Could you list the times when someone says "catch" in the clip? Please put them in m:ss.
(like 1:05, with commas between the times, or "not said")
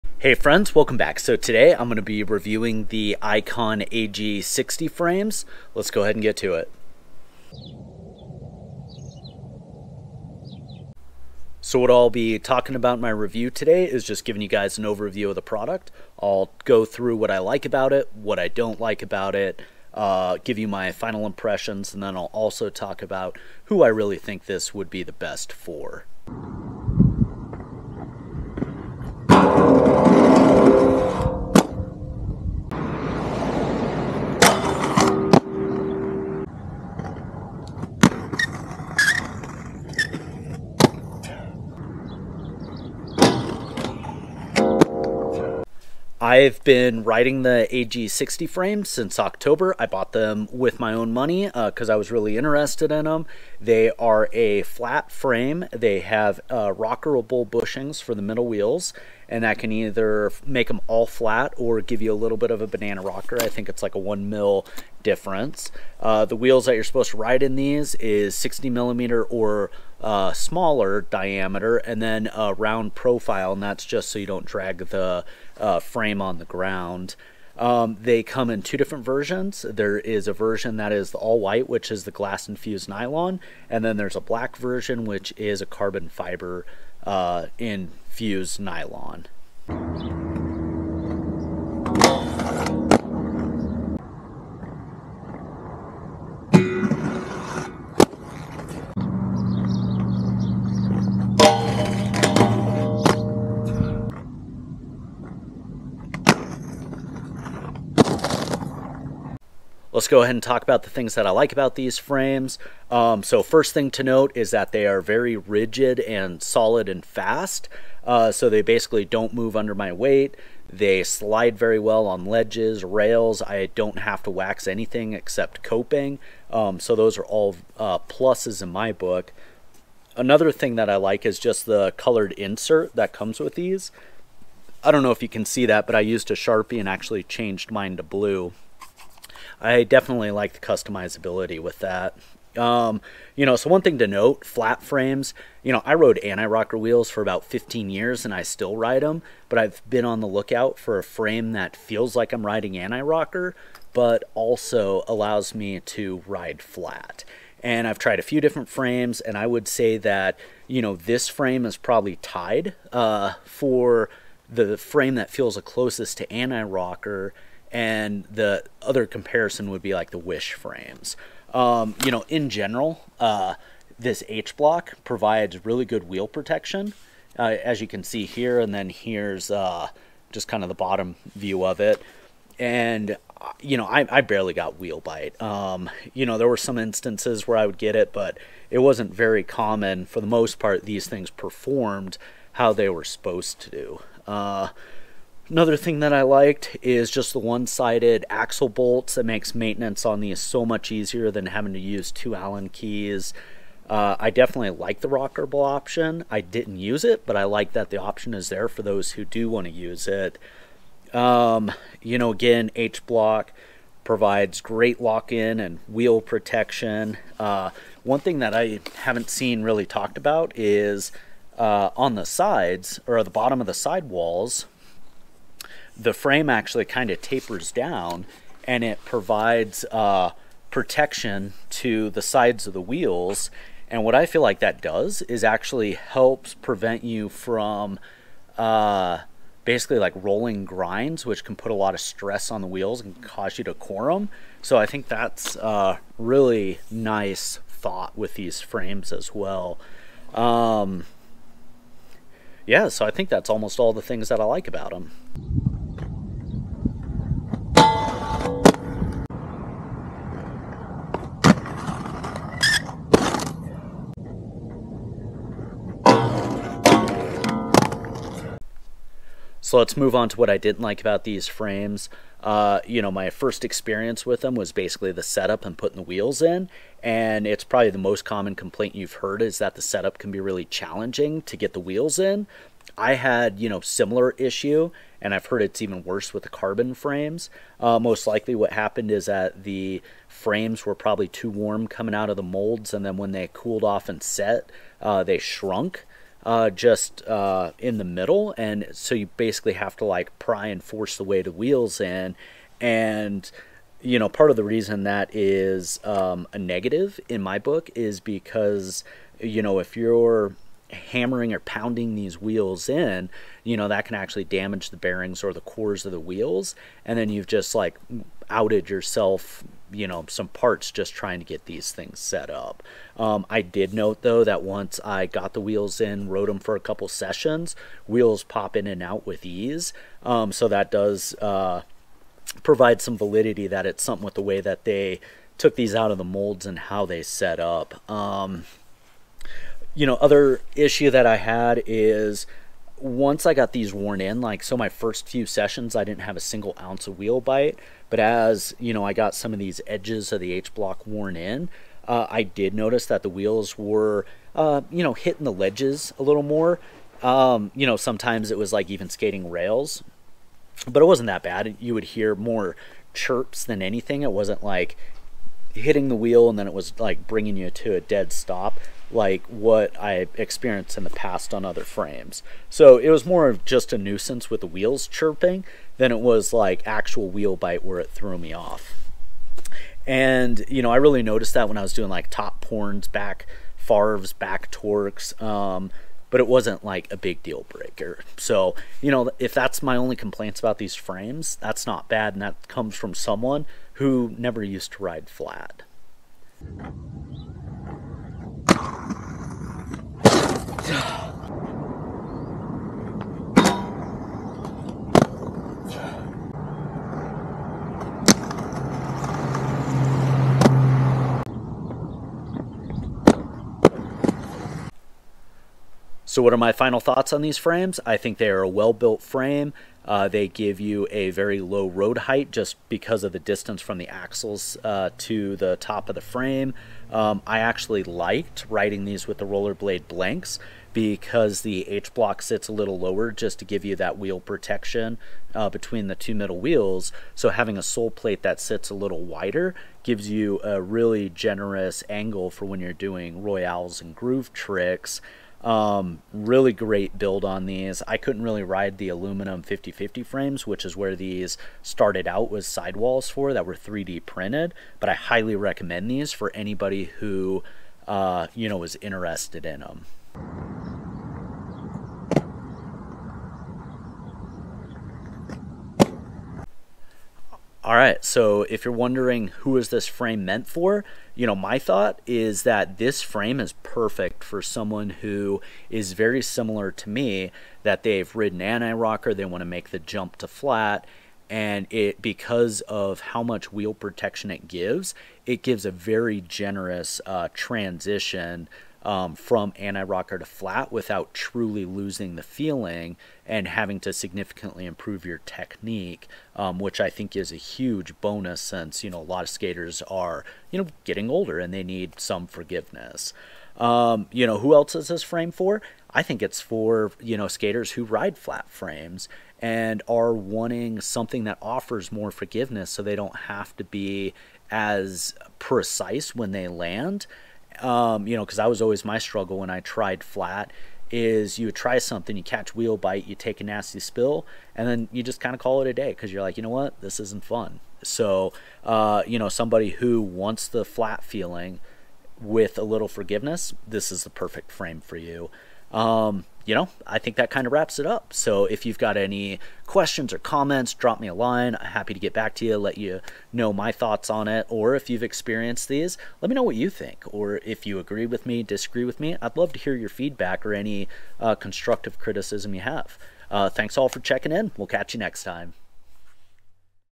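8:42, 9:14.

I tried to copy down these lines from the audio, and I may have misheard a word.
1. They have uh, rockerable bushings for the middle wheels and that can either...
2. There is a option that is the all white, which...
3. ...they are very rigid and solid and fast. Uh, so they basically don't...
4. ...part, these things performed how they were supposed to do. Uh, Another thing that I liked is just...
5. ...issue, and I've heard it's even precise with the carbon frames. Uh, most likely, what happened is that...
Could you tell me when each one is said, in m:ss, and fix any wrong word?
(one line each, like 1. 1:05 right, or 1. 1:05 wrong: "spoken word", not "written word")
1. 0:55 right
2. 1:19 wrong: "version", not "option"
3. 1:54 right
4. 3:10 right
5. 4:44 wrong: "worse", not "precise".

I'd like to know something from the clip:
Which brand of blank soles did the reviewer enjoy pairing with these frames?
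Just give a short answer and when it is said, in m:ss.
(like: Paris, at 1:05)
Rollerblade, at 7:09.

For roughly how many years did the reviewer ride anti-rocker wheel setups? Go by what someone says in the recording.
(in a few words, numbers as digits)
15.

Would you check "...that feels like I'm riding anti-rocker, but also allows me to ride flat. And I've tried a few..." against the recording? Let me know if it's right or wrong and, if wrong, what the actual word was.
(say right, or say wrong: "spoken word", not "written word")
right.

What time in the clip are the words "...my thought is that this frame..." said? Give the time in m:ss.
7:51.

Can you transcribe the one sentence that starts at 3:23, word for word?
Uh, I definitely like the rockable option.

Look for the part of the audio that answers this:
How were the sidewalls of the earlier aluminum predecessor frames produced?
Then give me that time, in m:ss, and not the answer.
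7:33.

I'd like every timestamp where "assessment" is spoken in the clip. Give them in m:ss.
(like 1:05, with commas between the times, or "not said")
not said.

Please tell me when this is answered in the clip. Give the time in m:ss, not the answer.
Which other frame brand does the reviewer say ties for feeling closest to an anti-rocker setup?
2:50.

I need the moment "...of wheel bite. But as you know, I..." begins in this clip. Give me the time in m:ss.
5:47.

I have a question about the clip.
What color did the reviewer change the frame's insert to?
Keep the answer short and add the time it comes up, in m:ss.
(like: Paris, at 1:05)
blue, at 2:18.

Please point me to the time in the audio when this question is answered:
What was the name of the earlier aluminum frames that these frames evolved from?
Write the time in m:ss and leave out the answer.
7:29.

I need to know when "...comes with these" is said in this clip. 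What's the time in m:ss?
2:13.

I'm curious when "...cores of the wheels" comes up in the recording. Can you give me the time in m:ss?
5:15.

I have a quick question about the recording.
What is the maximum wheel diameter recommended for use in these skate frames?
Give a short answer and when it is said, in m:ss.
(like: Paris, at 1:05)
60 millimeter, at 1:08.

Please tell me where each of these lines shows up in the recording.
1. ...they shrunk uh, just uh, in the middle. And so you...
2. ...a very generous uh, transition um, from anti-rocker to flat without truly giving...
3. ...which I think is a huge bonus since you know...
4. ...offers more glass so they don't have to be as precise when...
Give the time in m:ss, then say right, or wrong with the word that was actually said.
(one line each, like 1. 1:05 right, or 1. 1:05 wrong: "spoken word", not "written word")
1. 4:55 right
2. 8:05 wrong: "losing", not "giving"
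3. 8:16 right
4. 8:31 wrong: "forgiveness", not "glass".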